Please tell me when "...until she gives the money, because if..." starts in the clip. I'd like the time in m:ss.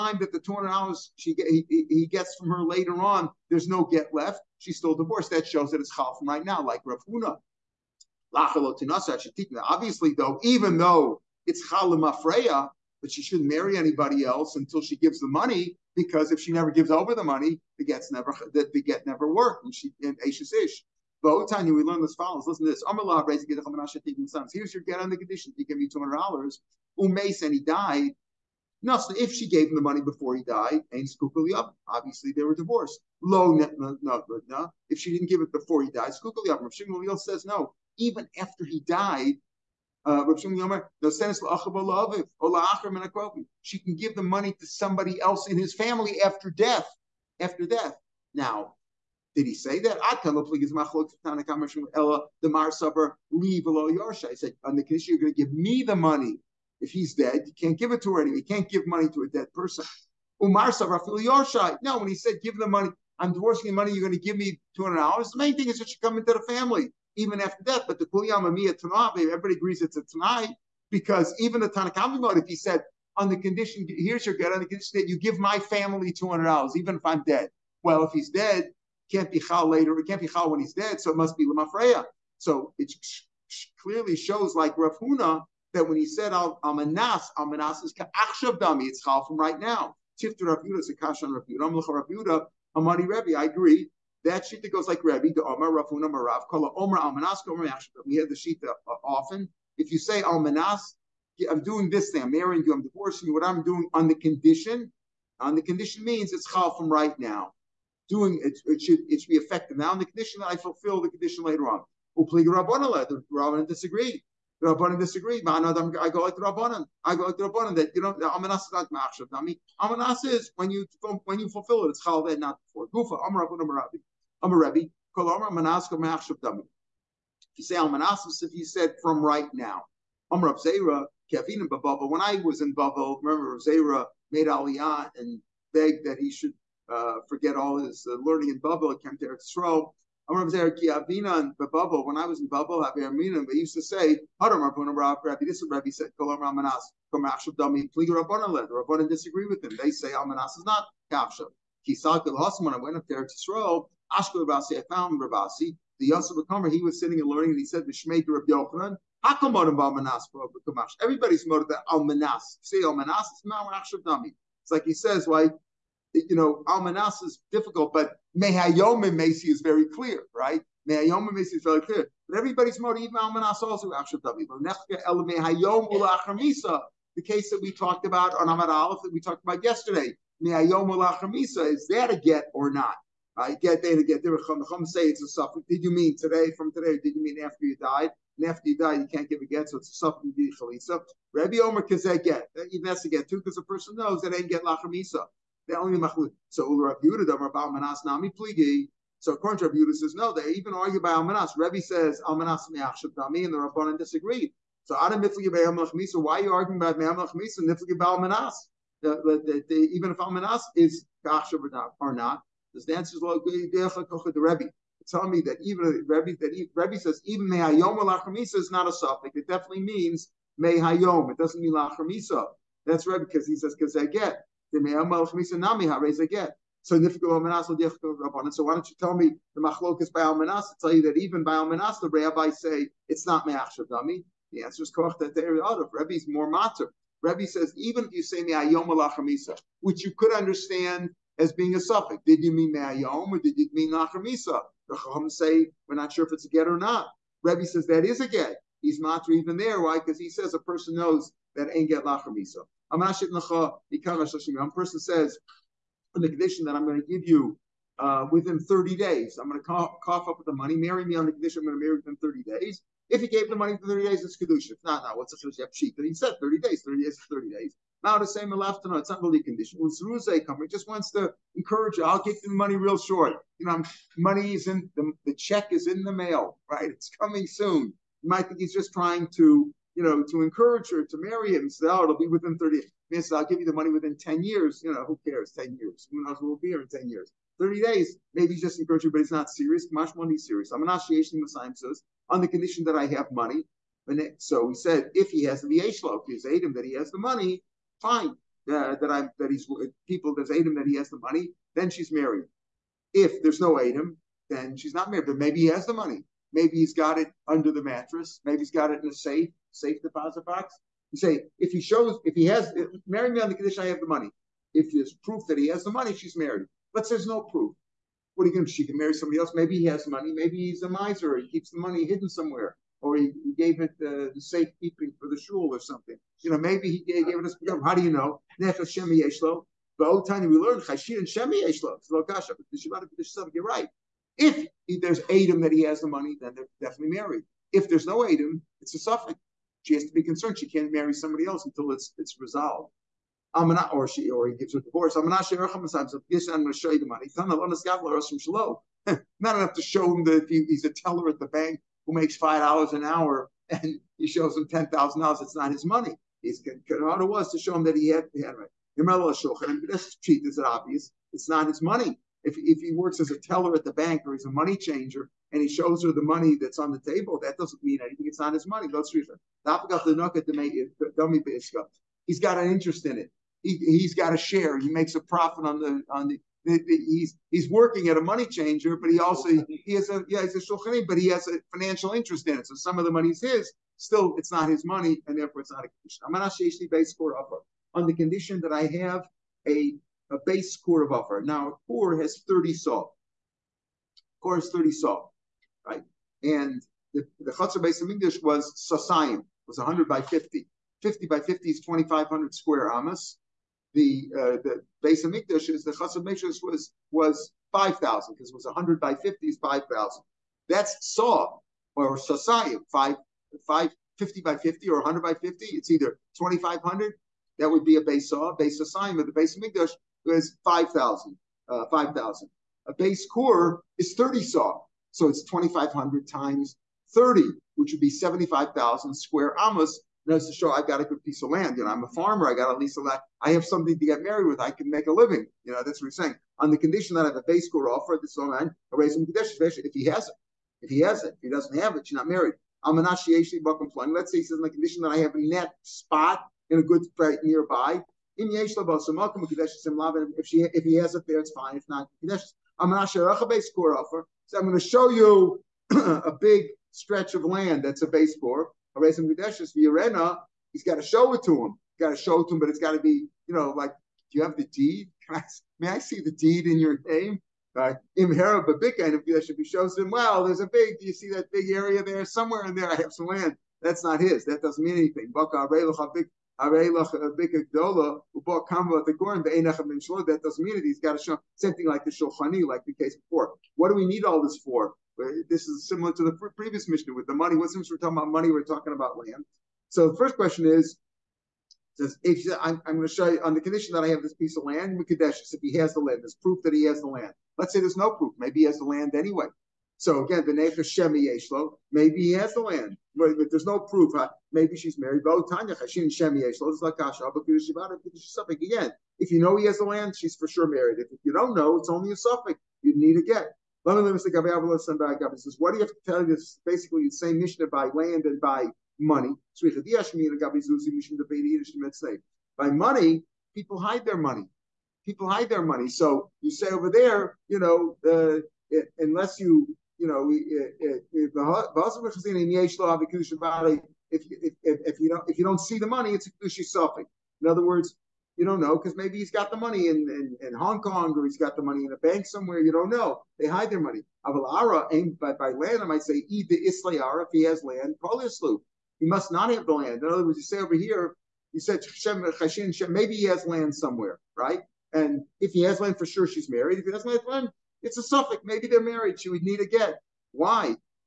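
0:14.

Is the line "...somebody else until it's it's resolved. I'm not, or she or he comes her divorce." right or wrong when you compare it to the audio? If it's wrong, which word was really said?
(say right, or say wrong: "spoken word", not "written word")
wrong: "gives", not "comes".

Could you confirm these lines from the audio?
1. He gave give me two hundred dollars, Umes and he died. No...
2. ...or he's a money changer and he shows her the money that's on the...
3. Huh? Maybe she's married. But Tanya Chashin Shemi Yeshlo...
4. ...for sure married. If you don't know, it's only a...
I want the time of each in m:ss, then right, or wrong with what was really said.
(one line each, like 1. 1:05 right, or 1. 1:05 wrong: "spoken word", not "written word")
1. 0:25 right
2. 6:04 right
3. 8:24 right
4. 8:30 right.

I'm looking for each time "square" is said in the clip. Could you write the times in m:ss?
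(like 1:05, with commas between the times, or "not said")
6:42, 7:09.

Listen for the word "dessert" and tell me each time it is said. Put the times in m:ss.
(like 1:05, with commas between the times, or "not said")
not said.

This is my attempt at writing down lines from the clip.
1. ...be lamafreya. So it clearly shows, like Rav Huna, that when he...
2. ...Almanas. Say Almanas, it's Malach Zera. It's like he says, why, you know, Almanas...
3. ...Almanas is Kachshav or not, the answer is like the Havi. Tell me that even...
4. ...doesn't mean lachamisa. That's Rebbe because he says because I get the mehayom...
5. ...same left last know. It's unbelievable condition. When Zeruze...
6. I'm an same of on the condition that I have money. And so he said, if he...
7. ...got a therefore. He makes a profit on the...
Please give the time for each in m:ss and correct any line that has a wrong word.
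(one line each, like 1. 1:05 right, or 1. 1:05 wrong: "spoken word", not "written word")
1. 1:21 right
2. 2:41 wrong: "Shavdami", not "Zera"
3. 3:30 wrong: "Rebbe", not "Havi"
4. 3:41 right
5. 4:28 right
6. 4:50 right
7. 6:14 wrong: "share", not "therefore".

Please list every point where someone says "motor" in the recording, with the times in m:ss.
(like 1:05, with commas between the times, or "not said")
2:41, 2:52.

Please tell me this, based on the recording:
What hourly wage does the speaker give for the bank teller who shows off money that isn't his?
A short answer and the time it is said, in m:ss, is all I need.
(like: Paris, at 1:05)
5 dollars, at 5:52.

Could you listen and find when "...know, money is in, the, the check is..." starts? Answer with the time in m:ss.
4:33.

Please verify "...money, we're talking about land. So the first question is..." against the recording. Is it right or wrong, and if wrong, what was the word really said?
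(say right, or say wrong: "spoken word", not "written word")
right.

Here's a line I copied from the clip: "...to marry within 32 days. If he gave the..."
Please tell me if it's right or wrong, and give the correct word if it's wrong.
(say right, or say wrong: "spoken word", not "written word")
wrong: "30", not "32".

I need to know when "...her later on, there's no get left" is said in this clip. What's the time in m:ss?
0:02.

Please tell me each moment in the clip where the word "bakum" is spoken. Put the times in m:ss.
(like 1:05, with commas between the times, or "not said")
7:23.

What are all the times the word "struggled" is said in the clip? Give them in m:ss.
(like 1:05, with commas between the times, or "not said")
not said.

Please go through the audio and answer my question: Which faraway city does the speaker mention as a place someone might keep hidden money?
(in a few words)
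Hong Kong.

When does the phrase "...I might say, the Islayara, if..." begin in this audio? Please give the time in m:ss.
9:05.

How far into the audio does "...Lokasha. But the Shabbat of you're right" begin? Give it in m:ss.
5:32.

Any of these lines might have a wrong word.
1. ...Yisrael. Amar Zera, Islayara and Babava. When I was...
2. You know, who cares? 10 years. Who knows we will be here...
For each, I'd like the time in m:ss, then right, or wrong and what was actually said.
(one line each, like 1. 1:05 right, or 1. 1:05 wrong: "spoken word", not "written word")
1. 2:19 wrong: "Kiavina", not "Islayara"
2. 4:44 right.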